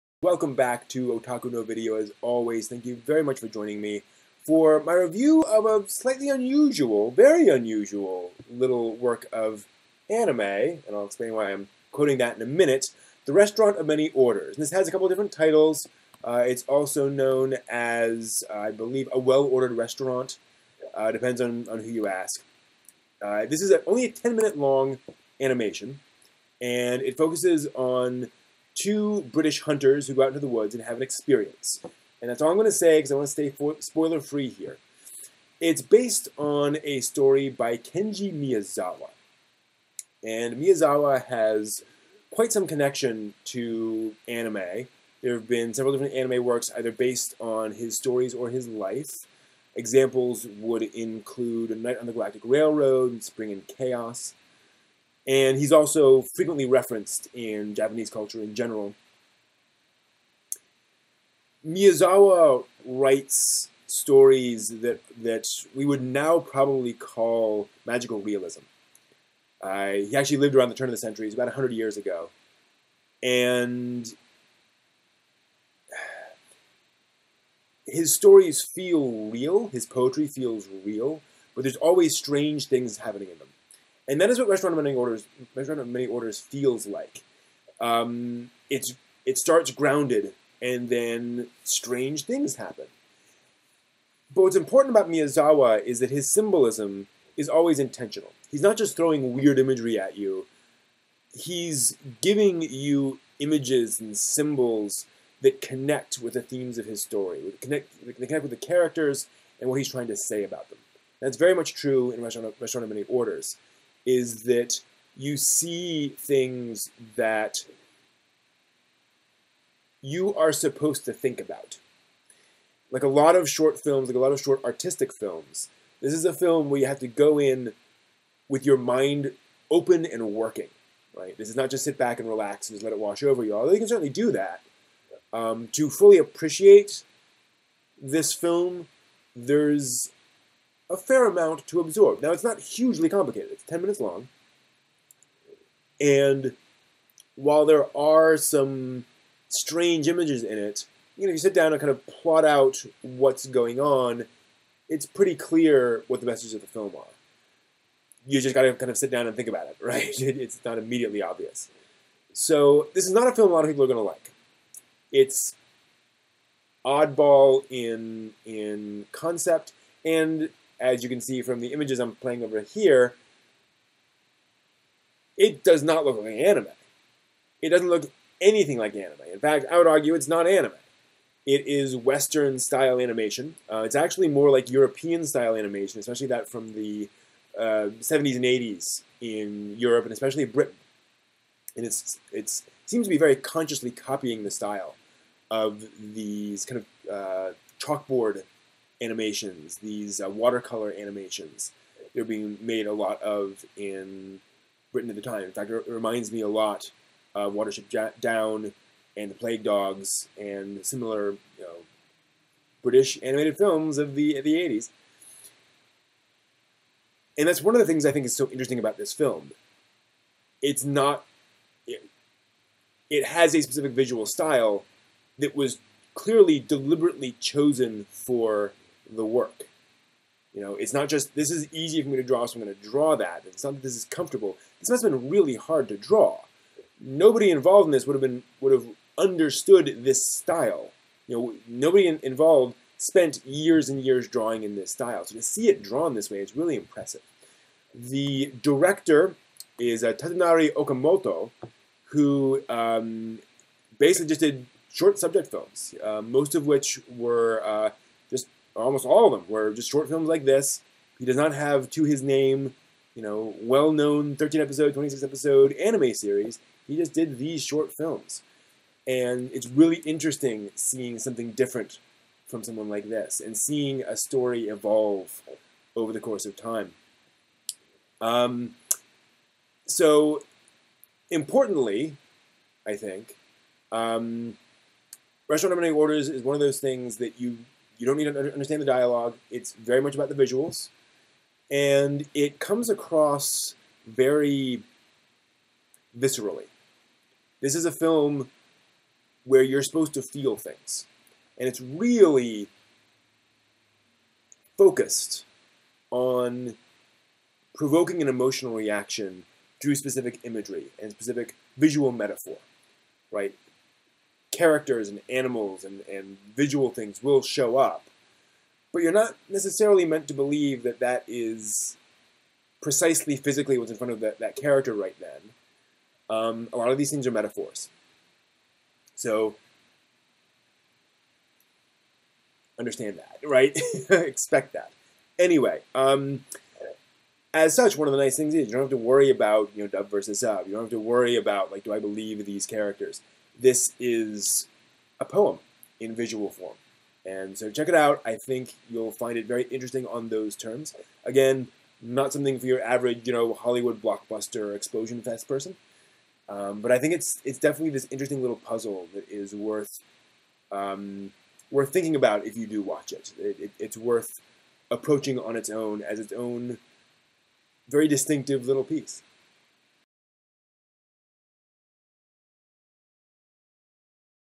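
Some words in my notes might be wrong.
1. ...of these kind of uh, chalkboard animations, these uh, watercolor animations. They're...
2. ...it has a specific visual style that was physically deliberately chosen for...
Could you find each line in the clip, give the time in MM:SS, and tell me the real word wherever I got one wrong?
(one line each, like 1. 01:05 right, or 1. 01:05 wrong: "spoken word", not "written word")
1. 03:15 right
2. 03:43 wrong: "clearly", not "physically".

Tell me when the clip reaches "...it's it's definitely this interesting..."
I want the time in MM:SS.
05:57.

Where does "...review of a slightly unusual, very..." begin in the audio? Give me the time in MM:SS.
00:04.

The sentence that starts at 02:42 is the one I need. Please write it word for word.
So this is not a film a lot of people are going to like.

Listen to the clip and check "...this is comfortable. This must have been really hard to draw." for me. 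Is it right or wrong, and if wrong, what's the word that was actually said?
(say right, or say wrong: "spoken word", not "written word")
right.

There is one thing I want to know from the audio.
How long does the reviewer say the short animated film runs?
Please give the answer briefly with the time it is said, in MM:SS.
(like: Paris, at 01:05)
10 minutes, at 00:24.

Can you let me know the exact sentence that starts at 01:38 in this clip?
He's not just throwing weird imagery at you.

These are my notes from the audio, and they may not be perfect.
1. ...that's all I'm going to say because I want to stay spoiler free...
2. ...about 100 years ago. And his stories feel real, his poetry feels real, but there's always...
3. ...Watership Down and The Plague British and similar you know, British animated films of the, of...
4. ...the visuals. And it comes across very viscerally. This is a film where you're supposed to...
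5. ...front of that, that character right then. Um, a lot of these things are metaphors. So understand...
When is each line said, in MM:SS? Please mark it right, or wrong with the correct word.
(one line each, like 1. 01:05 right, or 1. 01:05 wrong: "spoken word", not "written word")
1. 00:32 right
2. 01:11 right
3. 03:27 wrong: "Dogs", not "British"
4. 04:50 right
5. 05:23 right.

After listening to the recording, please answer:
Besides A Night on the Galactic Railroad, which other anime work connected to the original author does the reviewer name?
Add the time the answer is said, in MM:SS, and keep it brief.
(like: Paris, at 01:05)
Spring and Chaos, at 00:53.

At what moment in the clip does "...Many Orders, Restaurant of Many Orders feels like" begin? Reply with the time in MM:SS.
01:24.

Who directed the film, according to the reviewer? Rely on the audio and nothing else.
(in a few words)
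Tadanari Okamoto.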